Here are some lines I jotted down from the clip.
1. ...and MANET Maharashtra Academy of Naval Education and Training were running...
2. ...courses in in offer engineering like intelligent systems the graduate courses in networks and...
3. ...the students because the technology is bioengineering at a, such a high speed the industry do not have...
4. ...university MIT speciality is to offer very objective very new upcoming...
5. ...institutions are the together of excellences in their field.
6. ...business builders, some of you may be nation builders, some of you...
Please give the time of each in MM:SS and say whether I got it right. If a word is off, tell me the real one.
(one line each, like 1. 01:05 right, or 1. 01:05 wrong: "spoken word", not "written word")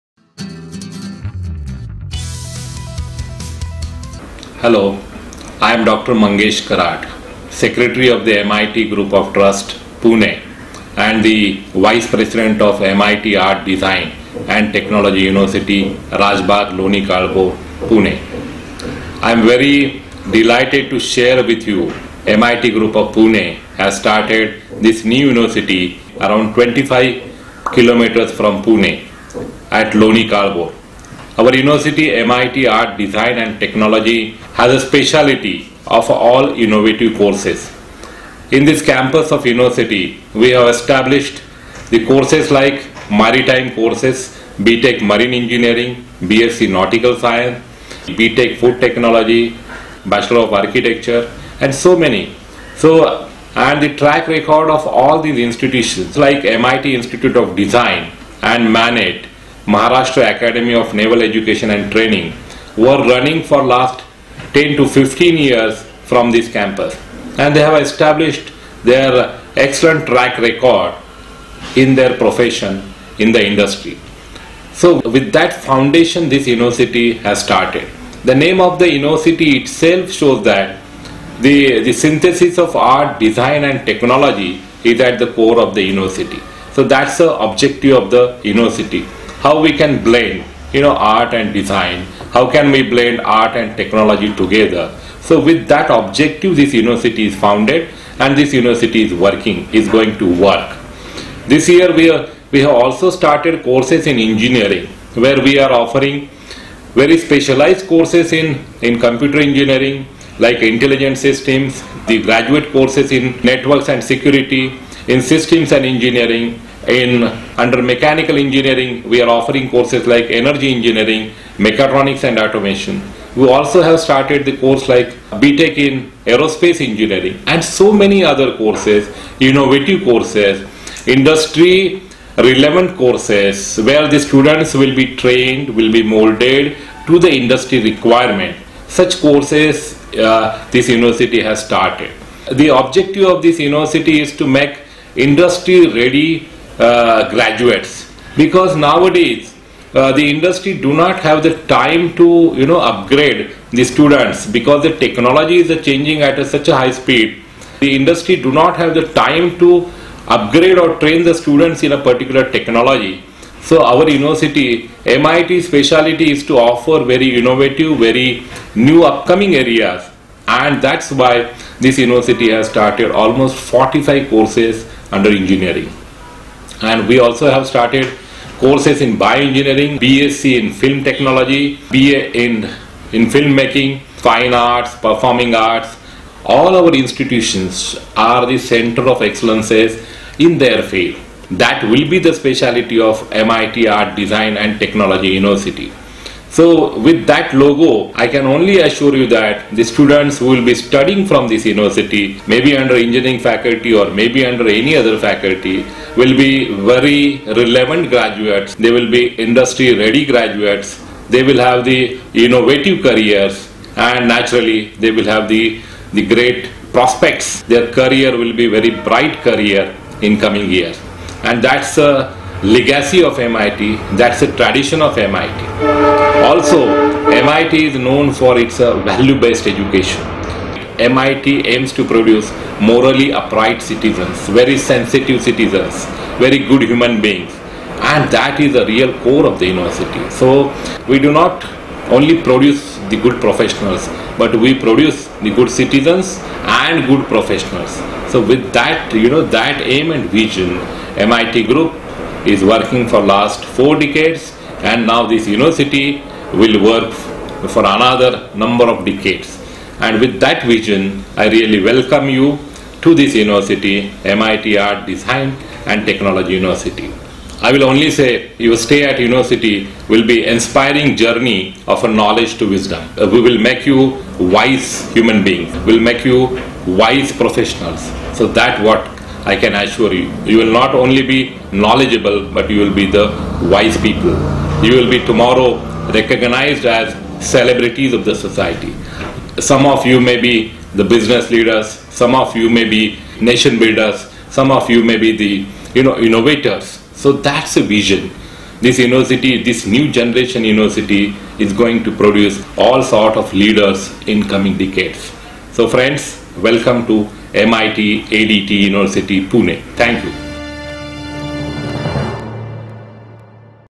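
1. 00:58 right
2. 01:47 wrong: "computer", not "offer"
3. 02:33 wrong: "changing", not "bioengineering"
4. 02:44 wrong: "innovative", not "objective"
5. 03:06 wrong: "center", not "together"
6. 04:51 wrong: "leaders", not "builders".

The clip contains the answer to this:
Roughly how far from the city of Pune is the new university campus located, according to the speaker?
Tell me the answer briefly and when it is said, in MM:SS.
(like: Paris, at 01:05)
25 kilometers, at 00:26.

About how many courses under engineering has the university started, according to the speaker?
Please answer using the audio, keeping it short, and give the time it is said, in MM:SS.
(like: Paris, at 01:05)
45, at 02:53.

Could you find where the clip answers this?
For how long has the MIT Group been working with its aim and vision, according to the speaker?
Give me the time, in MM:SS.
04:13.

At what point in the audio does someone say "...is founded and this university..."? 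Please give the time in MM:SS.
01:37.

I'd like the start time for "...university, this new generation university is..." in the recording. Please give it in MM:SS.
04:58.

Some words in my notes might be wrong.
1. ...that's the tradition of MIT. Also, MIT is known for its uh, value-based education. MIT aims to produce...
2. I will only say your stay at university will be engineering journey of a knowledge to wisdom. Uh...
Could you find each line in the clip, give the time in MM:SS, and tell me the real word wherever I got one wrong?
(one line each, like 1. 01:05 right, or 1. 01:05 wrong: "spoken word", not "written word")
1. 03:44 right
2. 04:27 wrong: "inspiring", not "engineering".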